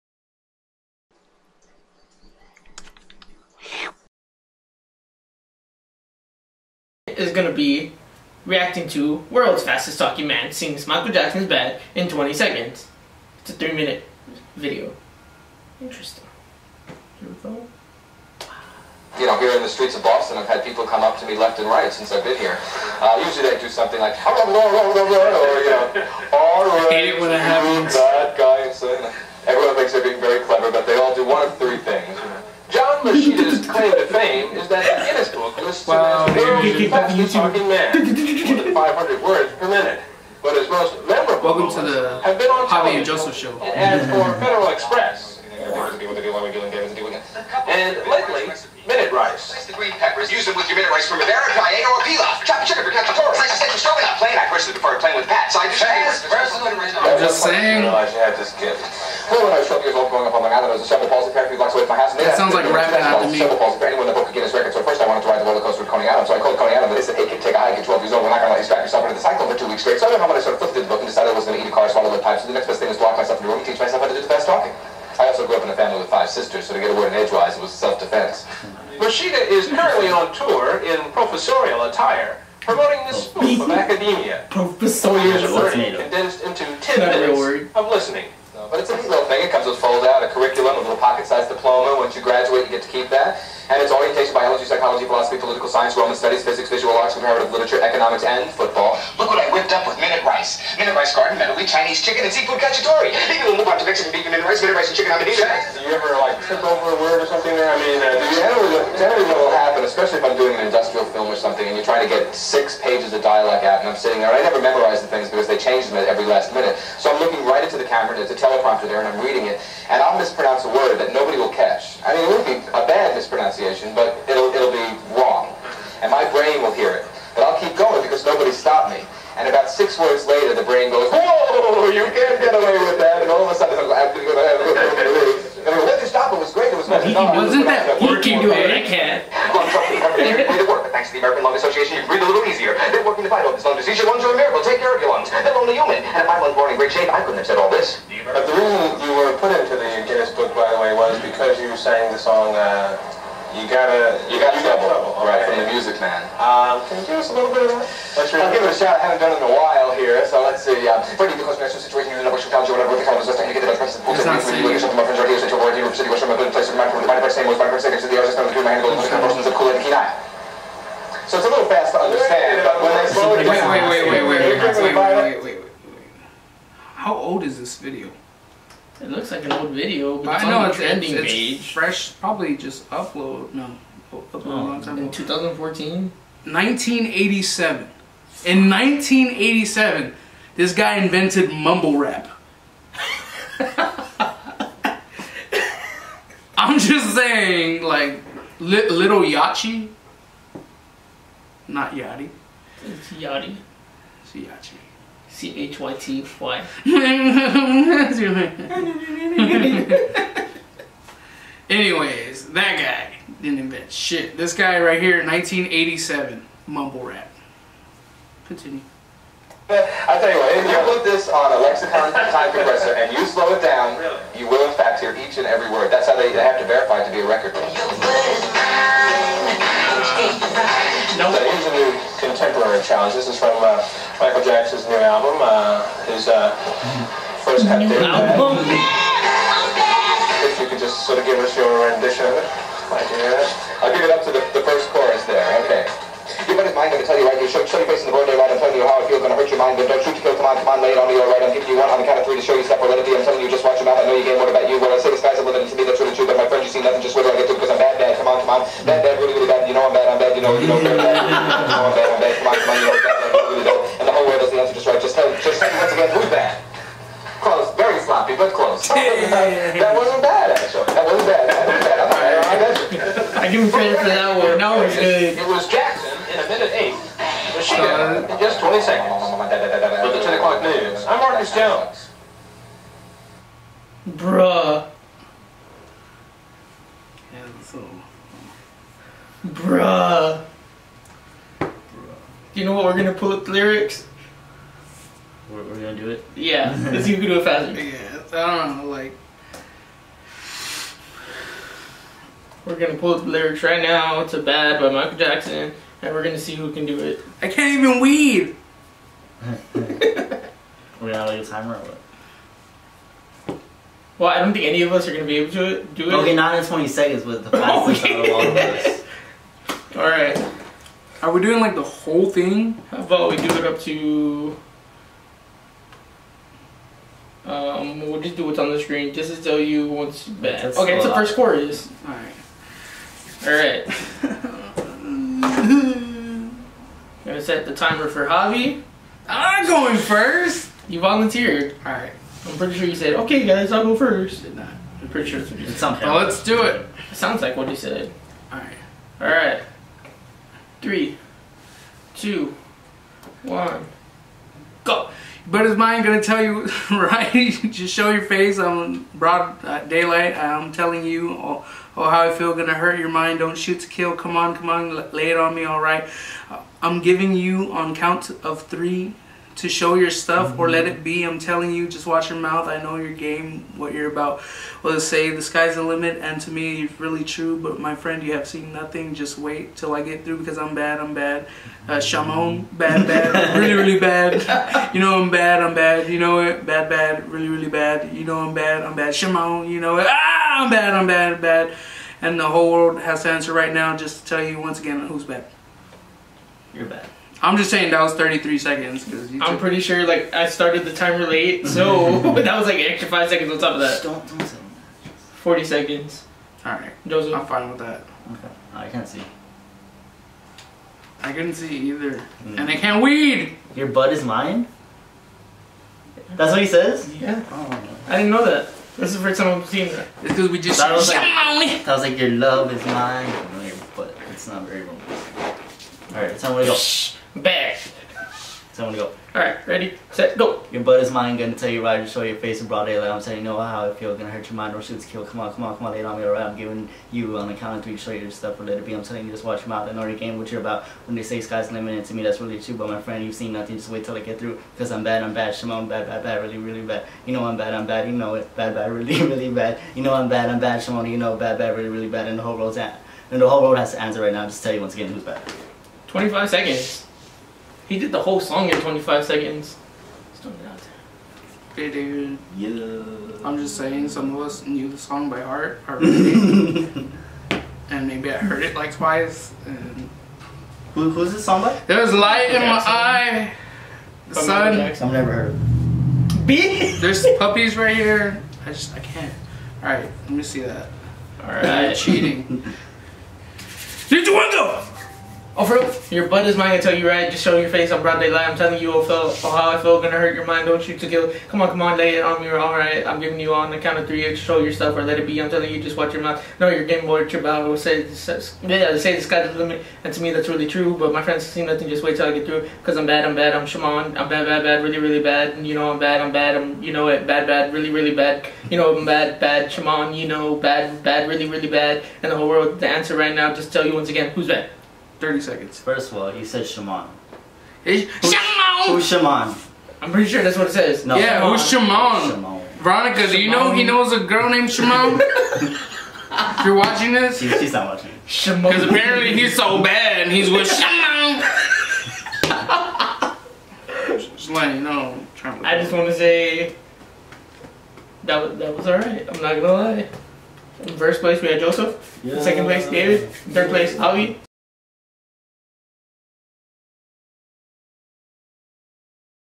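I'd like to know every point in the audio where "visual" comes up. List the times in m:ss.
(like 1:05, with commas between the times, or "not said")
1:36.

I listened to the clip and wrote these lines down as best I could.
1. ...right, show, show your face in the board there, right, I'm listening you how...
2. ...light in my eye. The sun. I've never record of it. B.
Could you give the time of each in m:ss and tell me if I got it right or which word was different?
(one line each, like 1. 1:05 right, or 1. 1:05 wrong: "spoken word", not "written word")
1. 4:07 wrong: "telling", not "listening"
2. 7:52 wrong: "heard", not "record".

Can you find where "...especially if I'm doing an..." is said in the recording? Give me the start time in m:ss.
1:49.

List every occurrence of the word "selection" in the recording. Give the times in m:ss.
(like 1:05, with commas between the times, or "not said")
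not said.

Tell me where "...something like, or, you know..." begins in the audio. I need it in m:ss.
0:23.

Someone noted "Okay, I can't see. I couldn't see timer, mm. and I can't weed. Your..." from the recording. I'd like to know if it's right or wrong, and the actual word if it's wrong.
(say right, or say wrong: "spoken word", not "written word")
wrong: "either", not "timer".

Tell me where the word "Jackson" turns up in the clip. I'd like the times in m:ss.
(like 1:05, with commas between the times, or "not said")
0:11, 3:54, 5:05.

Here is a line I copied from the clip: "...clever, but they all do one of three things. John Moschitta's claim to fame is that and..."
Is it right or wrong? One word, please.
right.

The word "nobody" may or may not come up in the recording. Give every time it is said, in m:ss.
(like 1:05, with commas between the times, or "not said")
2:01, 2:08.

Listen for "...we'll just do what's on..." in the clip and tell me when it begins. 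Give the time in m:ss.
5:28.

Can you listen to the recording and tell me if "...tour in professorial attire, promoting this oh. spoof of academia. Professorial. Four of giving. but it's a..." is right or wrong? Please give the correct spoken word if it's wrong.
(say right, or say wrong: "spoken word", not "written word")
wrong: "listening", not "giving".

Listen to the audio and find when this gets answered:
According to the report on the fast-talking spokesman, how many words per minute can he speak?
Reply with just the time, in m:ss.
0:38.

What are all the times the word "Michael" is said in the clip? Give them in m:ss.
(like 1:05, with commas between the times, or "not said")
0:10, 3:54, 5:04.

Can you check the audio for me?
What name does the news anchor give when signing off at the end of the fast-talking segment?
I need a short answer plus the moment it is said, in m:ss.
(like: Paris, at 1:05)
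Marcus Jones, at 4:41.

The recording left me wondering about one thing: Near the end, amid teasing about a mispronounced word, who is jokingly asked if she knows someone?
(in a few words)
Veronica.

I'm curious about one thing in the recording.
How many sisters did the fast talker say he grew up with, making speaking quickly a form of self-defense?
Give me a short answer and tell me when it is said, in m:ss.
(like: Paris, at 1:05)
5, at 1:16.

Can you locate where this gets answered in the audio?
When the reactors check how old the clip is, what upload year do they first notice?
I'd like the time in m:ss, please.
3:05.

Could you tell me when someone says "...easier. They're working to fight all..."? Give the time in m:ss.
2:22.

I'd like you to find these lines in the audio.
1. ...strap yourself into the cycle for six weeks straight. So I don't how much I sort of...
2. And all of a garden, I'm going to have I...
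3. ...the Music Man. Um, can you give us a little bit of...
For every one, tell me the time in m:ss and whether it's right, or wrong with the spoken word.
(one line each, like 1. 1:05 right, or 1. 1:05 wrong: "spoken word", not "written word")
1. 1:08 wrong: "two", not "six"
2. 2:13 wrong: "sudden", not "garden"
3. 2:35 right.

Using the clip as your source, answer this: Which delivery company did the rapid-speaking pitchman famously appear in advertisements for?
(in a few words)
Federal Express.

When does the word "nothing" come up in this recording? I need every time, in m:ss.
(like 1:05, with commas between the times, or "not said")
4:16, 6:18, 7:23, 8:21.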